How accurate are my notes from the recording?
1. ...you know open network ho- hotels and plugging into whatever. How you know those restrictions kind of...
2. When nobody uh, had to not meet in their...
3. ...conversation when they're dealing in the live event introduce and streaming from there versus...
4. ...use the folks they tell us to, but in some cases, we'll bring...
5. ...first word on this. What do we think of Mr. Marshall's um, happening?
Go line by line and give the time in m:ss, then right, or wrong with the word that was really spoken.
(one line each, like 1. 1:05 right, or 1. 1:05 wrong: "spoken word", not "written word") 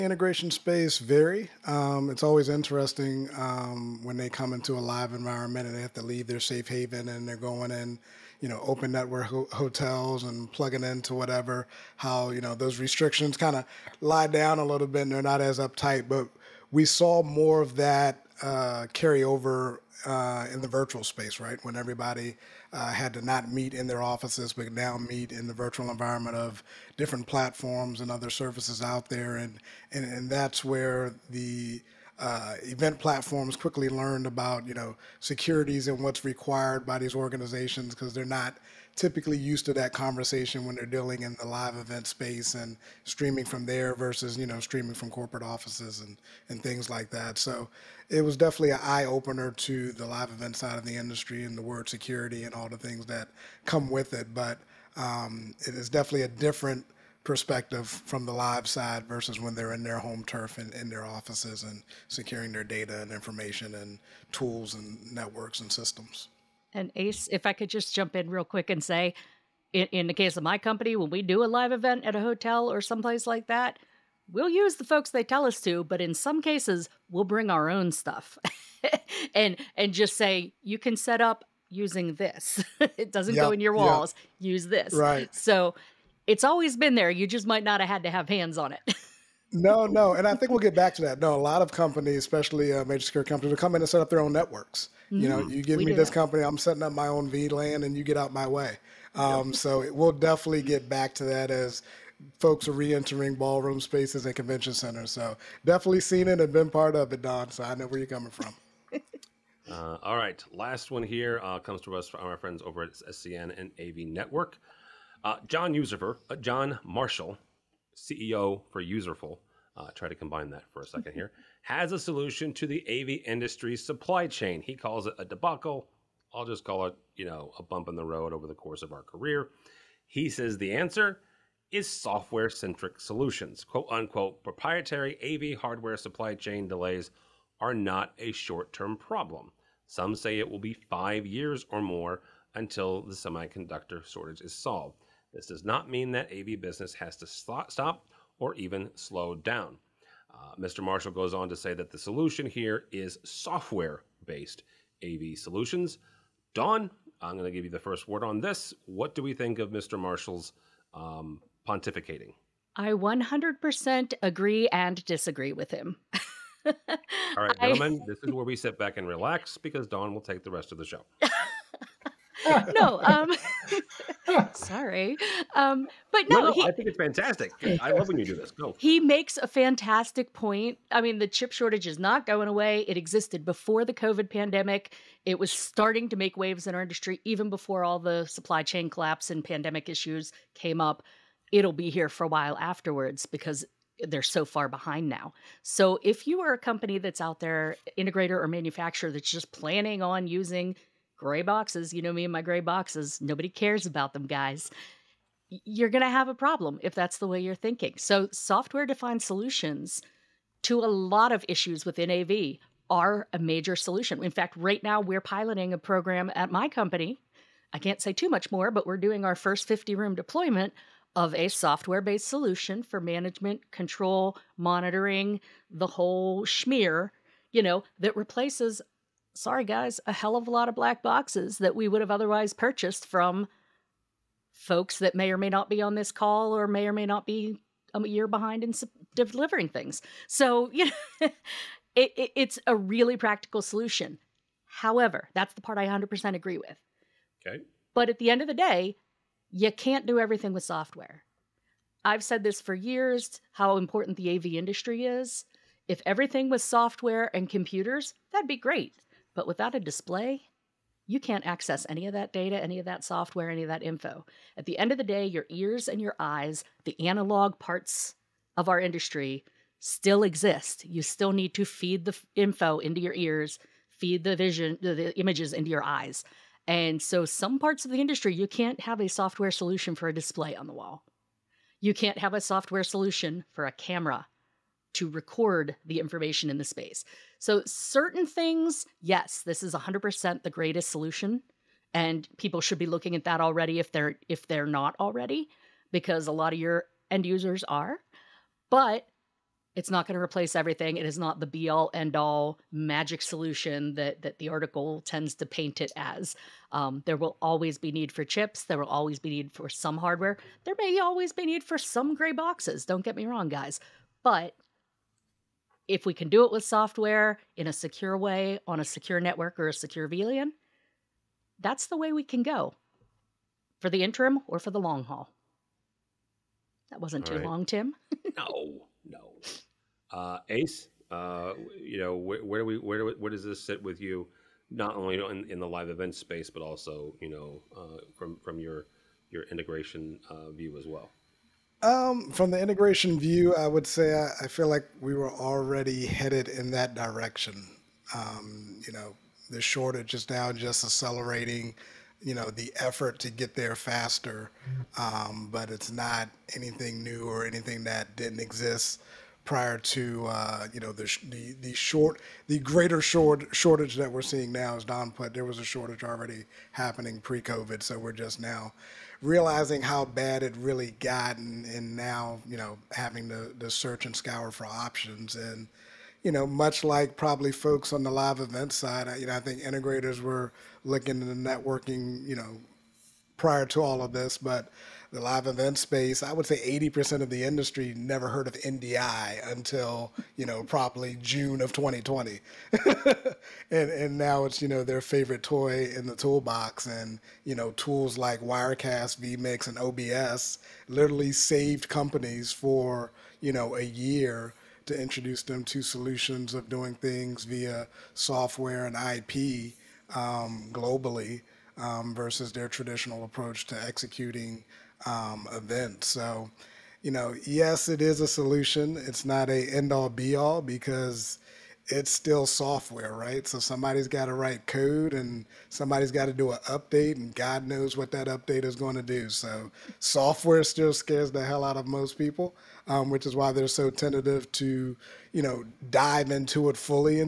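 1. 0:08 right
2. 0:21 wrong: "everybody", not "nobody"
3. 0:39 wrong: "space", not "introduce"
4. 1:14 right
5. 2:37 wrong: "pontificating", not "happening".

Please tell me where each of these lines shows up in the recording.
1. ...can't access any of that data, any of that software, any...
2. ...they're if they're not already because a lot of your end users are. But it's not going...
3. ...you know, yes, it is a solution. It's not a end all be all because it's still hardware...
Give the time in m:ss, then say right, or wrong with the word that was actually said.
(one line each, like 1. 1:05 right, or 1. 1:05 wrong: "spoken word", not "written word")
1. 4:21 right
2. 4:53 right
3. 6:57 wrong: "software", not "hardware".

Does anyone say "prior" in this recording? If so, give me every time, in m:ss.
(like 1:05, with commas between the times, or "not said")
5:59, 6:23.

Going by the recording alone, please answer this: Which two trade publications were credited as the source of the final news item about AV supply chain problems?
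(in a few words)
SCN and AV Network.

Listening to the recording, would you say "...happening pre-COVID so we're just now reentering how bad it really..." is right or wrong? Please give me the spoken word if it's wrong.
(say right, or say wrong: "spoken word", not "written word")
wrong: "realizing", not "reentering".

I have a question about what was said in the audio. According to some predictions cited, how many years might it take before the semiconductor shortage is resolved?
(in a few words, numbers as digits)
5 years or more.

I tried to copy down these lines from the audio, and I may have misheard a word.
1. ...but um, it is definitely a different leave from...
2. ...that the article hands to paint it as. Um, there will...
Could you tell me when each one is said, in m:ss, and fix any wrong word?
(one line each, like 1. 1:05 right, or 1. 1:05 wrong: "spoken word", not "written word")
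1. 0:54 wrong: "perspective", not "leave"
2. 5:04 wrong: "tends", not "hands".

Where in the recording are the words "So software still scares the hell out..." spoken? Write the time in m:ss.
7:09.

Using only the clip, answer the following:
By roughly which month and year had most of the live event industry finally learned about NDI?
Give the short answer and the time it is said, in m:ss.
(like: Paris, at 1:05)
June 2020, at 6:31.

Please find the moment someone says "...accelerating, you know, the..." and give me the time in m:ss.
5:50.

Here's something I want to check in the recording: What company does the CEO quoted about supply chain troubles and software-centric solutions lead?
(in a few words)
Userful.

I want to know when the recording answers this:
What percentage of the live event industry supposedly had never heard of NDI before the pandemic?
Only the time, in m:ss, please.
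6:26.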